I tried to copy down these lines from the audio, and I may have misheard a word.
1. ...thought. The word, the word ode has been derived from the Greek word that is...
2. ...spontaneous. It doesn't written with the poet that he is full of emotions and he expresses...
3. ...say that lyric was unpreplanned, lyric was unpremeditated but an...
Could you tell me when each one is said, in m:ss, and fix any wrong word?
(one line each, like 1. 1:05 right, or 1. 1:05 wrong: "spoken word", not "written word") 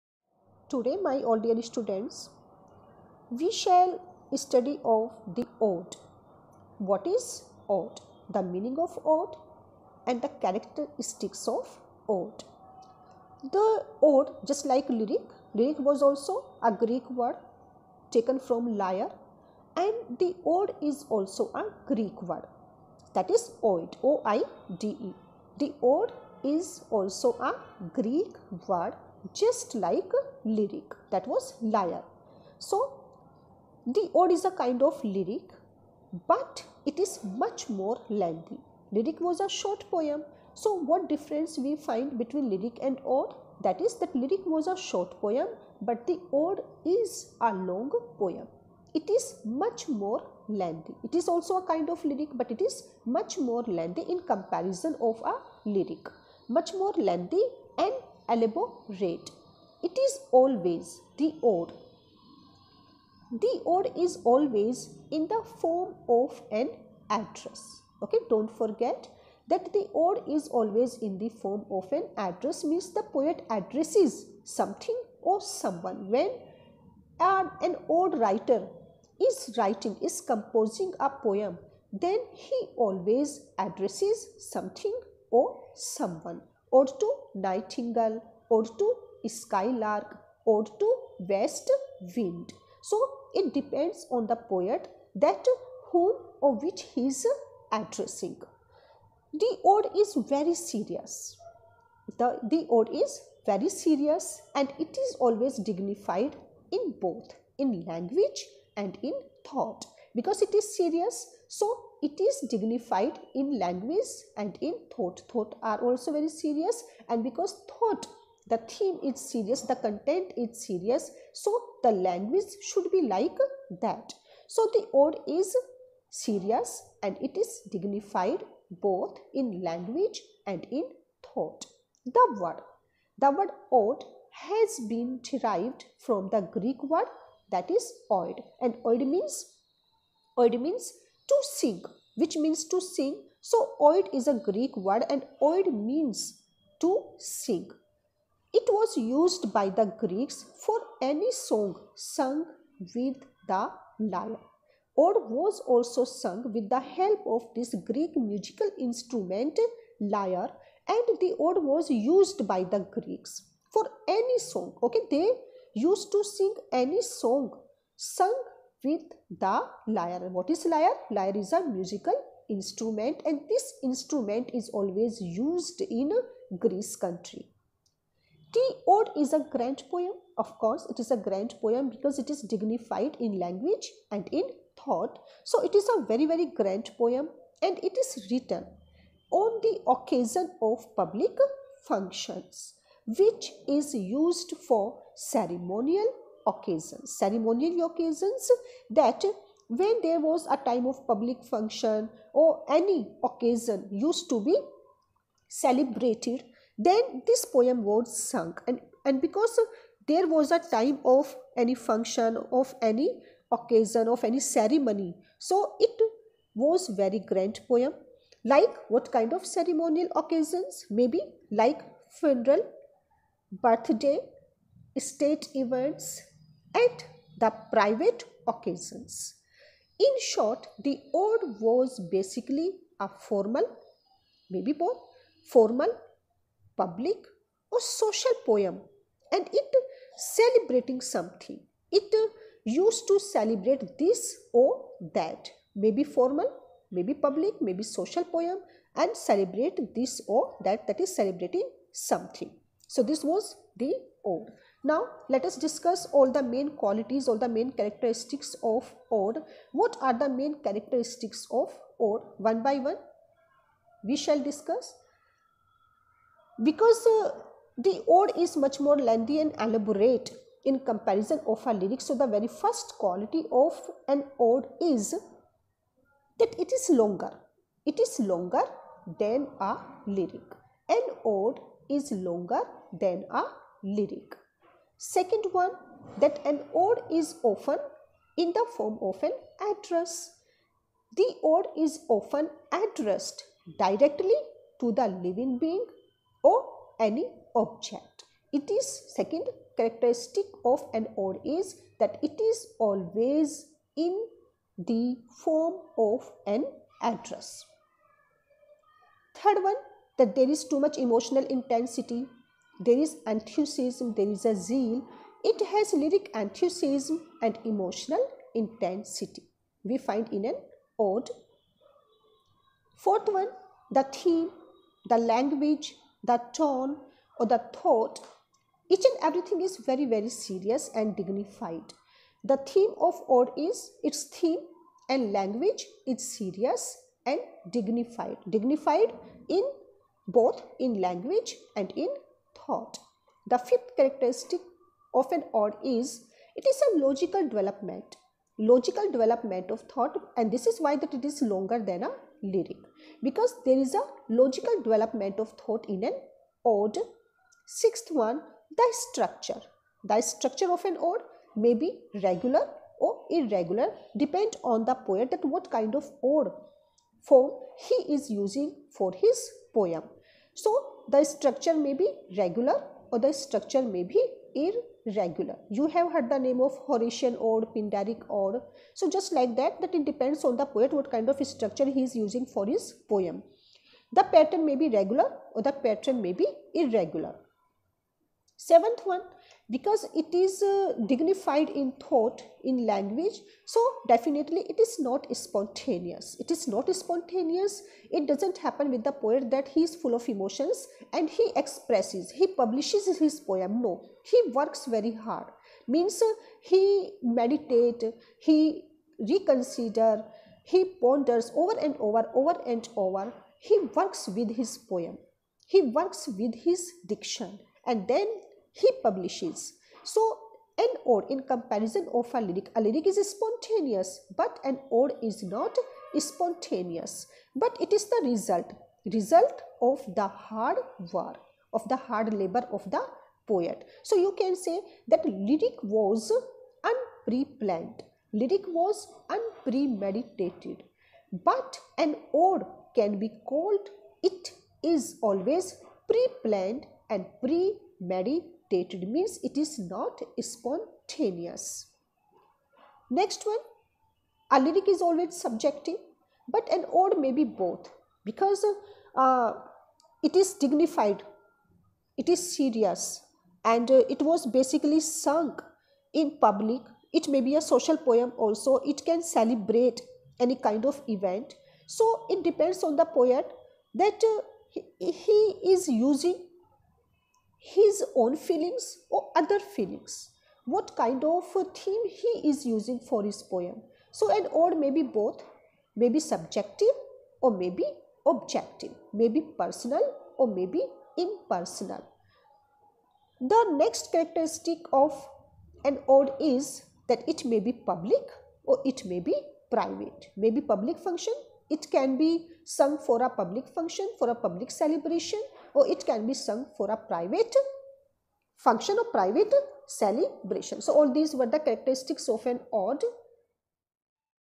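1. 2:11 right
2. 6:36 wrong: "happen", not "written"
3. 7:14 right.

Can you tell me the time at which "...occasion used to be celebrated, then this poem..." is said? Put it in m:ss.
3:23.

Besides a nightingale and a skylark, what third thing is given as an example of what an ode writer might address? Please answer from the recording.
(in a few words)
west wind.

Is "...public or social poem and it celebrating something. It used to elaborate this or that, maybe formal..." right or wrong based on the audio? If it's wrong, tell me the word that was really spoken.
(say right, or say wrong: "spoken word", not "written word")
wrong: "celebrate", not "elaborate".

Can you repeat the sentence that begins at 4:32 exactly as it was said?
So the very first quality of an ode is that it is longer.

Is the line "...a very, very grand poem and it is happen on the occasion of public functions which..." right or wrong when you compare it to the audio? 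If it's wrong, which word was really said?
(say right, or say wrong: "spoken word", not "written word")
wrong: "written", not "happen".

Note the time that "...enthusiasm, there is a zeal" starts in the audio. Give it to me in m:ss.
5:13.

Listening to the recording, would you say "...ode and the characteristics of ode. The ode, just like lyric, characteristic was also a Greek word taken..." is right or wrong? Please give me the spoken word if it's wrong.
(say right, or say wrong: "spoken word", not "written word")
wrong: "lyric", not "characteristic".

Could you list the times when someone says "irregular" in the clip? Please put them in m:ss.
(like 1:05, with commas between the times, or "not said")
6:03, 6:14, 6:26.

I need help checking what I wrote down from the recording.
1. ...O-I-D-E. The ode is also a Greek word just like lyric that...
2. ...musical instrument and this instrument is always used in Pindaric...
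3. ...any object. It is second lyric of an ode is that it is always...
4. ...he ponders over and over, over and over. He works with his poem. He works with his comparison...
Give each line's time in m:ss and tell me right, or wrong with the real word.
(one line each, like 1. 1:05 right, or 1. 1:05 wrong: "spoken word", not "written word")
1. 0:24 right
2. 2:51 wrong: "Greece", not "Pindaric"
3. 4:56 wrong: "characteristic", not "lyric"
4. 6:50 wrong: "diction", not "comparison".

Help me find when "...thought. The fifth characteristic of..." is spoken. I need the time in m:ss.
5:42.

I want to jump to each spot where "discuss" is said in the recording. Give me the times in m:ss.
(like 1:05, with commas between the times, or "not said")
4:15, 4:24.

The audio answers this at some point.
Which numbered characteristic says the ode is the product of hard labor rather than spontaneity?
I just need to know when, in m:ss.
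6:28.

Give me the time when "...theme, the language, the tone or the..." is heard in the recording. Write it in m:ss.
5:24.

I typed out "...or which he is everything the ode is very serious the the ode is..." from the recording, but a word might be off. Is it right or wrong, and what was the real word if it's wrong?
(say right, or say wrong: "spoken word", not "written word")
wrong: "addressing", not "everything".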